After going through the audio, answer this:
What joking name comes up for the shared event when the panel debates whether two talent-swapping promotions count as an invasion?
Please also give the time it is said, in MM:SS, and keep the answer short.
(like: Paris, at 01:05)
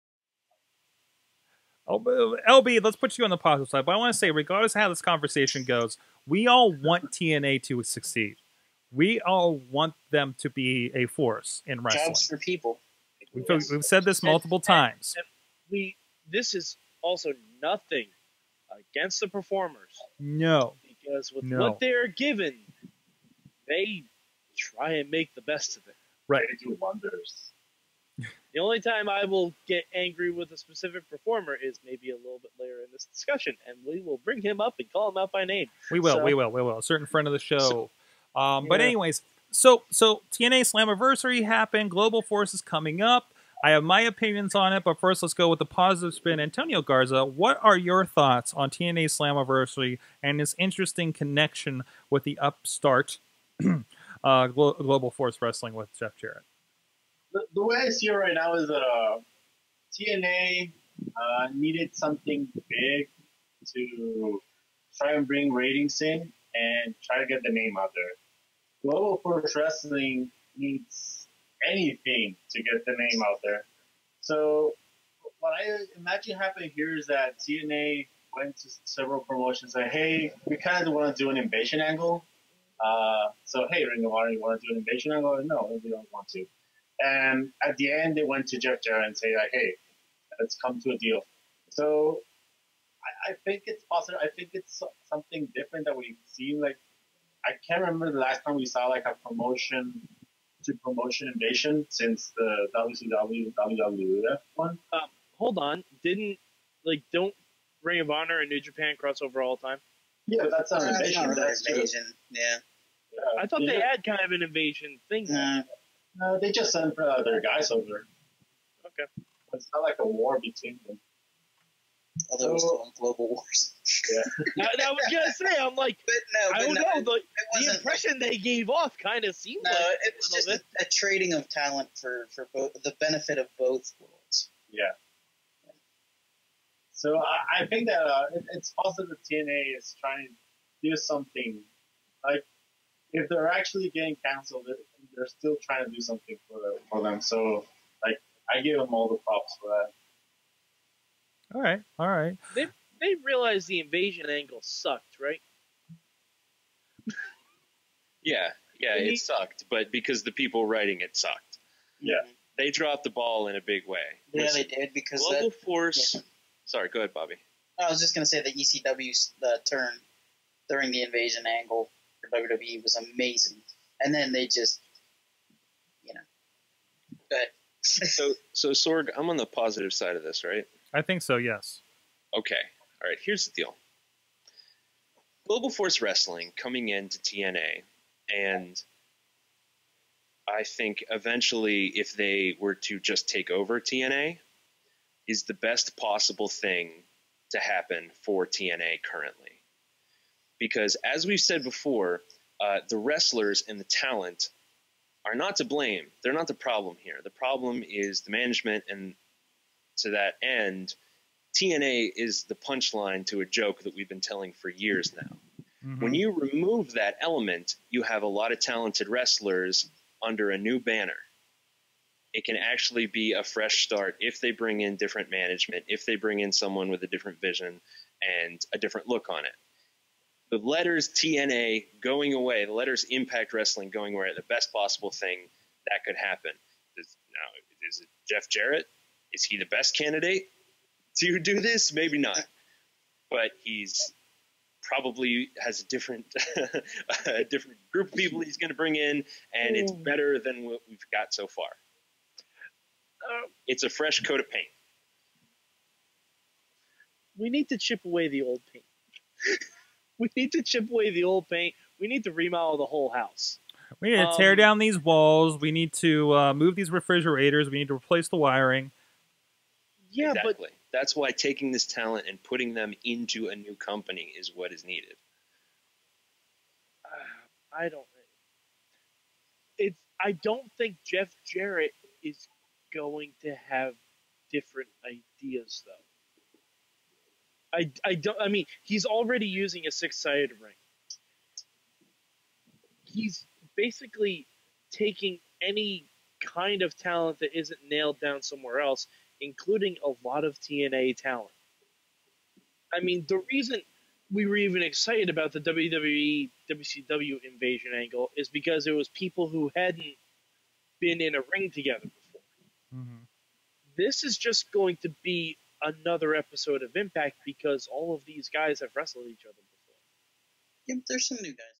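Global Wars, at 02:02.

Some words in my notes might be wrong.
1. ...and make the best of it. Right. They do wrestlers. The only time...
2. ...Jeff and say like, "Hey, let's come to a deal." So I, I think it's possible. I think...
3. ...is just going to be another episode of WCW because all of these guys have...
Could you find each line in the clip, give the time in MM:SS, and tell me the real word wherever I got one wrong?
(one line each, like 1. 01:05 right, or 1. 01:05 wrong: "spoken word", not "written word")
1. 00:24 wrong: "wonders", not "wrestlers"
2. 01:28 right
3. 05:14 wrong: "Impact", not "WCW".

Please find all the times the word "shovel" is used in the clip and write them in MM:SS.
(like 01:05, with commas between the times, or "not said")
not said.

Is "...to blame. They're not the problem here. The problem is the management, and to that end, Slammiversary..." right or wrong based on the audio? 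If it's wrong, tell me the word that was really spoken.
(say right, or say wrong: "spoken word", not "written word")
wrong: "TNA", not "Slammiversary".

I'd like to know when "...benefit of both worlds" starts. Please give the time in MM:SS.
02:12.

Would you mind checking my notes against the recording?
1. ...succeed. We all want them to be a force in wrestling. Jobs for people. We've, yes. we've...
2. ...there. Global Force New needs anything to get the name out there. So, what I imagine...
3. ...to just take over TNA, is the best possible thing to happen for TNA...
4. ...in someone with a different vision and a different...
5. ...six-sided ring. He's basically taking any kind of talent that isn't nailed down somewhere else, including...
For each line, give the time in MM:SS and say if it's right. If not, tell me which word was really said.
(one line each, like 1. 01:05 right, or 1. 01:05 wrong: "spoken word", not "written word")
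1. 00:07 right
2. 01:07 wrong: "Wrestling", not "New"
3. 03:12 right
4. 03:46 right
5. 04:49 right.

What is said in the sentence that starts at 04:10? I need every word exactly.
better than what we've got so far.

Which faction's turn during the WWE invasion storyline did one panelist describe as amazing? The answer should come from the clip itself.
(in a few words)
ECW.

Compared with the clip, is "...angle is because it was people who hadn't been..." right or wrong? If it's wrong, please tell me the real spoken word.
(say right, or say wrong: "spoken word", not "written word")
right.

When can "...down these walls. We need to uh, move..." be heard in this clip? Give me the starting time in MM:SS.
04:24.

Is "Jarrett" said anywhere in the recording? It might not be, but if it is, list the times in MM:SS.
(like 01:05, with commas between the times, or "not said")
00:56, 03:58, 04:41.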